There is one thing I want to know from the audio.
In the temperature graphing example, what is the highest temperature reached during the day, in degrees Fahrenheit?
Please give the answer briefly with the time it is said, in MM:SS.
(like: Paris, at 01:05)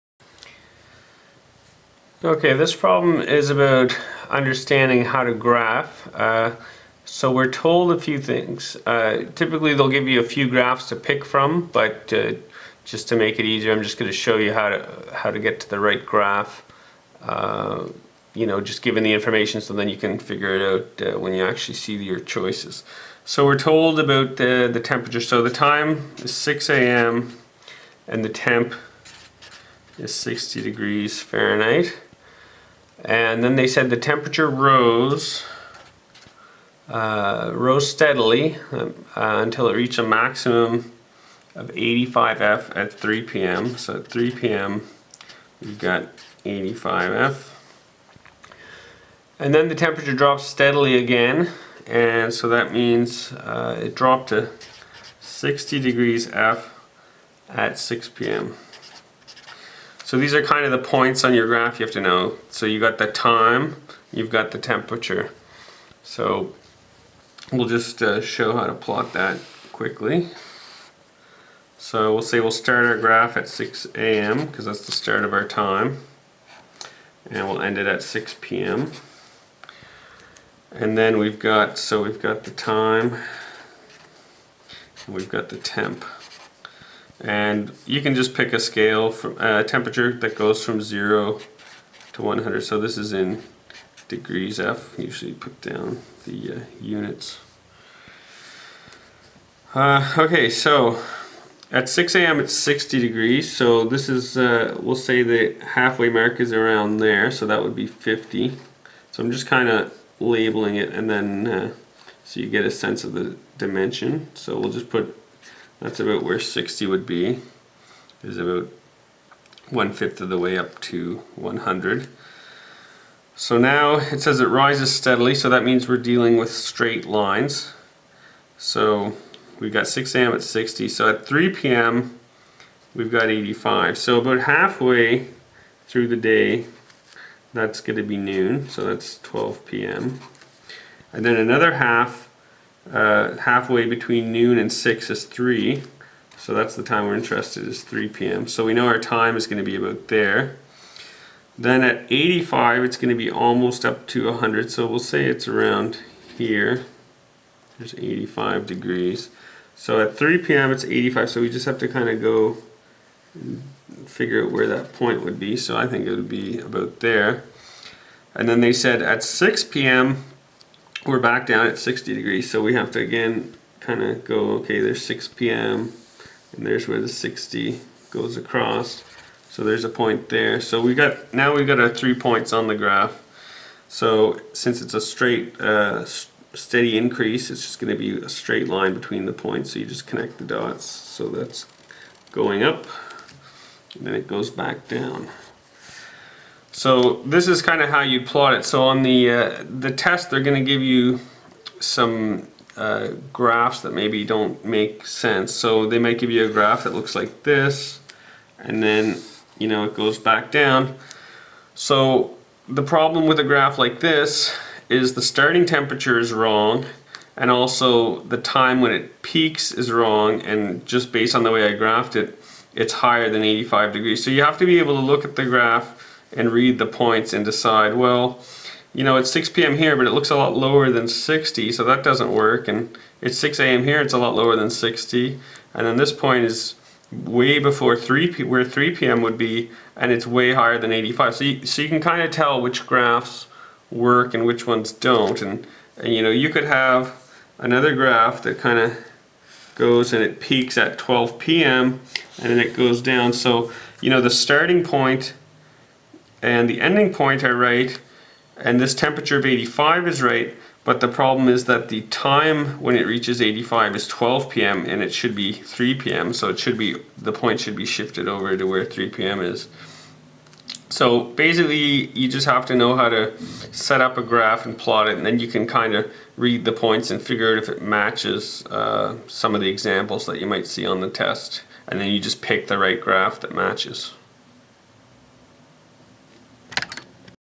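85, at 00:39.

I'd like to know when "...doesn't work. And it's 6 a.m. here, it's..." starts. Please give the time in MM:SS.
03:52.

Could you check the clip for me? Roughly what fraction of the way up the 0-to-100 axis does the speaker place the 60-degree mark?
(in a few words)
one fifth.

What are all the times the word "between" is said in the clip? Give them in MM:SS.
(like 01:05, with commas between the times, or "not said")
02:23, 03:08.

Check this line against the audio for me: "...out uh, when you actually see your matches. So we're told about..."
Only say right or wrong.
wrong.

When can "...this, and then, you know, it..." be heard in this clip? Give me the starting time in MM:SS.
03:27.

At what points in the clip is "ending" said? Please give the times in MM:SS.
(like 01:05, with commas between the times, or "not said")
04:16.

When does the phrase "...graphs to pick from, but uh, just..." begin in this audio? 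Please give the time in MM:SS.
00:10.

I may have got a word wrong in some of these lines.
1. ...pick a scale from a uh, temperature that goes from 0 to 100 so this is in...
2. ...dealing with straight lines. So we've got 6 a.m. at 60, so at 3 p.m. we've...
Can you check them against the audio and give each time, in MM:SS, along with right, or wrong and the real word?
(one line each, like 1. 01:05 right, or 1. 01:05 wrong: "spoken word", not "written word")
1. 01:28 right
2. 02:05 right.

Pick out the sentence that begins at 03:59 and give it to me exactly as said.
would be, and it's way higher than 85.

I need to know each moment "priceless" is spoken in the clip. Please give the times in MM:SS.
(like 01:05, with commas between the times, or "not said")
not said.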